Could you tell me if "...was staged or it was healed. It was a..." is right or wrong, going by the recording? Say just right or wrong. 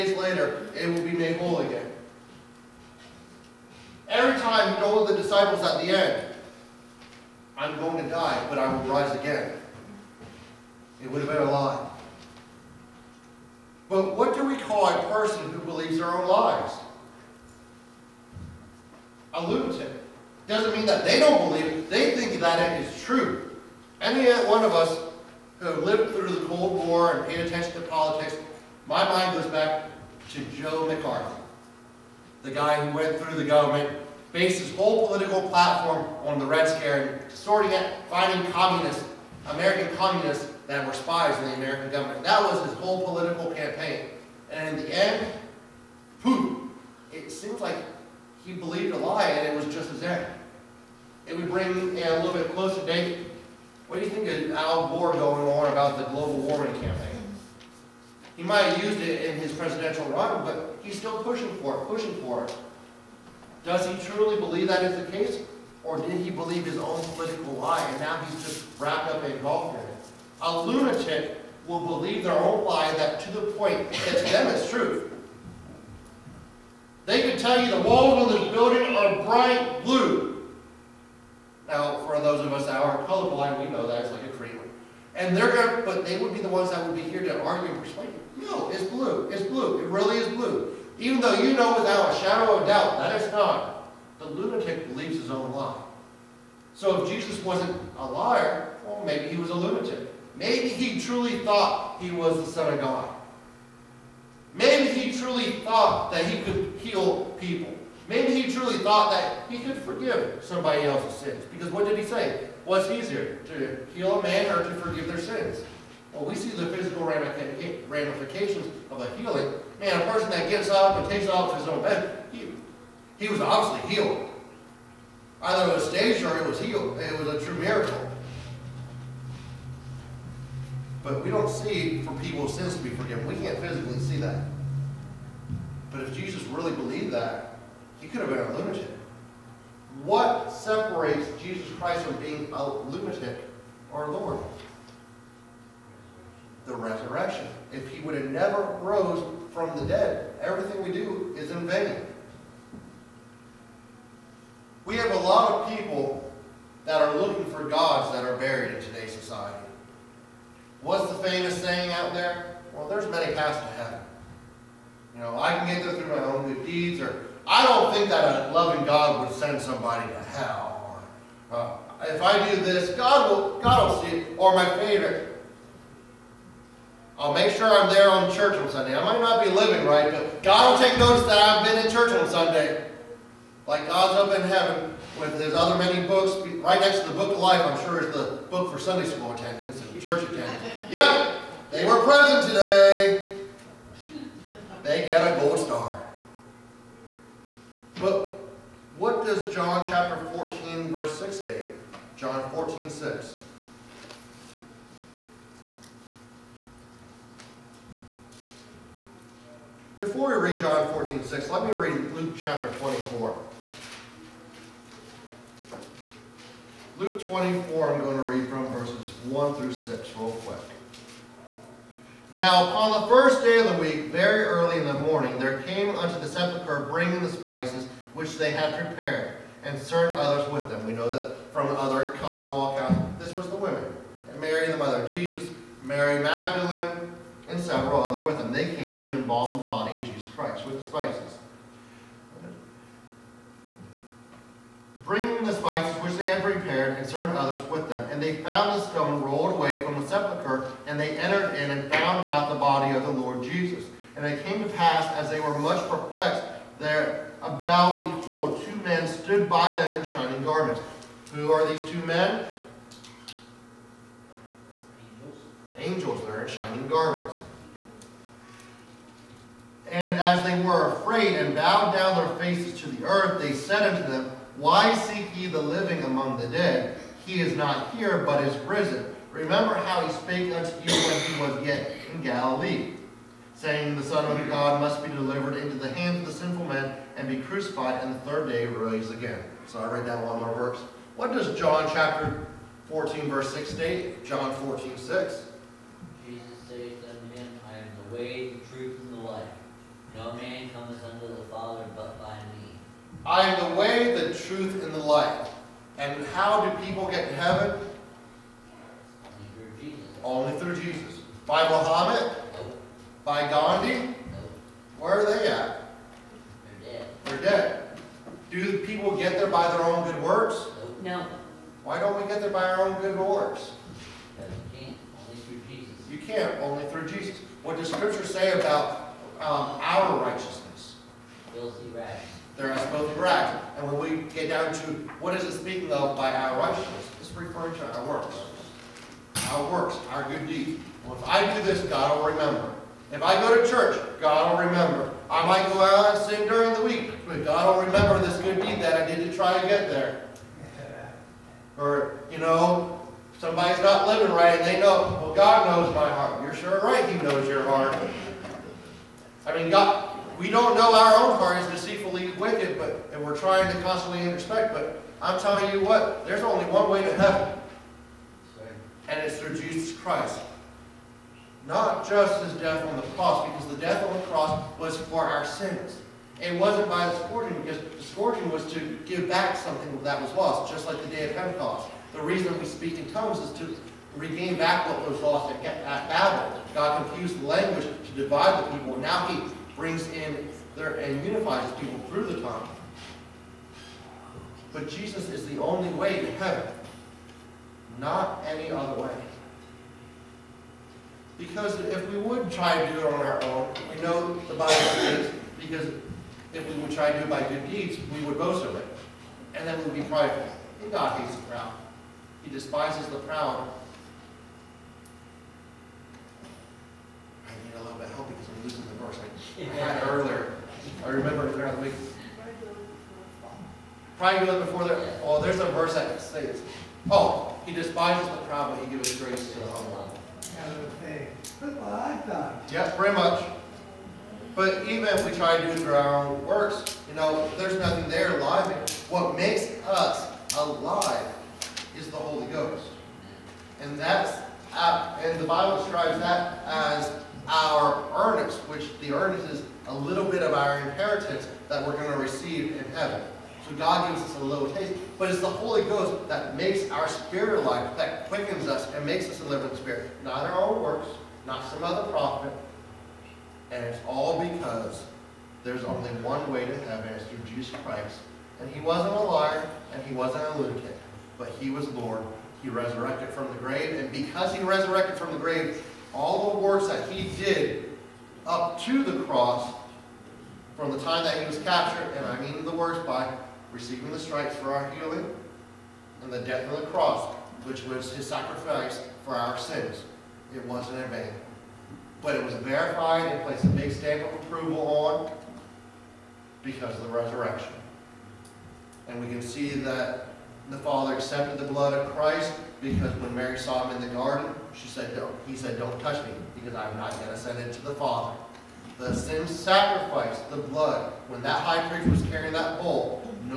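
right.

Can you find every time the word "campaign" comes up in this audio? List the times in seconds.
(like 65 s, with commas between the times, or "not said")
43 s, 56 s.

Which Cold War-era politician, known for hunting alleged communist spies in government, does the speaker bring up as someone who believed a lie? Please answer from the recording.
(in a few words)
Joe McCarthy.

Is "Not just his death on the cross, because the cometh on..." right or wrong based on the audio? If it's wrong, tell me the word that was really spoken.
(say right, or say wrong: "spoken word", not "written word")
wrong: "death", not "cometh".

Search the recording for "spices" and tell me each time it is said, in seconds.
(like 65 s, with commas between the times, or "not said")
227 s, 240 s, 245 s.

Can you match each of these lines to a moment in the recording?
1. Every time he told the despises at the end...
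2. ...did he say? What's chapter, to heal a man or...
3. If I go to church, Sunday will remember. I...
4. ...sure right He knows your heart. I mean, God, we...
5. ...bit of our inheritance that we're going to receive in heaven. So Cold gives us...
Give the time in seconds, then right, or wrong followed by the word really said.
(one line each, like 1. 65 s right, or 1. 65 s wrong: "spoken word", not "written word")
1. 4 s wrong: "disciples", not "despises"
2. 111 s wrong: "easier", not "chapter"
3. 343 s wrong: "God", not "Sunday"
4. 356 s right
5. 450 s wrong: "God", not "Cold".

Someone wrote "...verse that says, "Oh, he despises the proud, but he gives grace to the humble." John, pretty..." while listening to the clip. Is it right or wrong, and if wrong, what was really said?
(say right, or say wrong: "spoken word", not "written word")
wrong: "Yeah", not "John".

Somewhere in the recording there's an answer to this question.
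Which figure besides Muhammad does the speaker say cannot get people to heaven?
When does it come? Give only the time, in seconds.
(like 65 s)
313 s.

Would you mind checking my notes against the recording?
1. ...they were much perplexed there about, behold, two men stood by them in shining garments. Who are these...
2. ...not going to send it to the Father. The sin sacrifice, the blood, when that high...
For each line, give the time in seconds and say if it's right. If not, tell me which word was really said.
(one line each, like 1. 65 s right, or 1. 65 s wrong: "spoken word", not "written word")
1. 255 s right
2. 506 s right.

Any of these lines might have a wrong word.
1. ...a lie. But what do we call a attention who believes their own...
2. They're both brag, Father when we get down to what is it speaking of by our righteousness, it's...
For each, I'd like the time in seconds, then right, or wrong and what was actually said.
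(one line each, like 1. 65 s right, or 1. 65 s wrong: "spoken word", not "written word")
1. 11 s wrong: "person", not "attention"
2. 332 s wrong: "And", not "Father".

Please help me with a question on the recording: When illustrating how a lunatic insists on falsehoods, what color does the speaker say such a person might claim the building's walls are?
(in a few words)
Bright blue.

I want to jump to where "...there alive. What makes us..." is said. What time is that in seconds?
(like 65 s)
438 s.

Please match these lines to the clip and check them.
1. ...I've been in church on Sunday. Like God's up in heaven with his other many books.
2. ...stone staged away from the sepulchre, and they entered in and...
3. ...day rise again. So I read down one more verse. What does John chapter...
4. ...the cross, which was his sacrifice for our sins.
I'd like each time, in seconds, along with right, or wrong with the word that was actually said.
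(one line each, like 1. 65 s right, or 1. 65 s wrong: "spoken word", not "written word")
1. 181 s right
2. 248 s wrong: "rolled", not "staged"
3. 288 s right
4. 486 s right.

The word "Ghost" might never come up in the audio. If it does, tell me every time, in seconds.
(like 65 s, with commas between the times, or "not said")
442 s, 455 s.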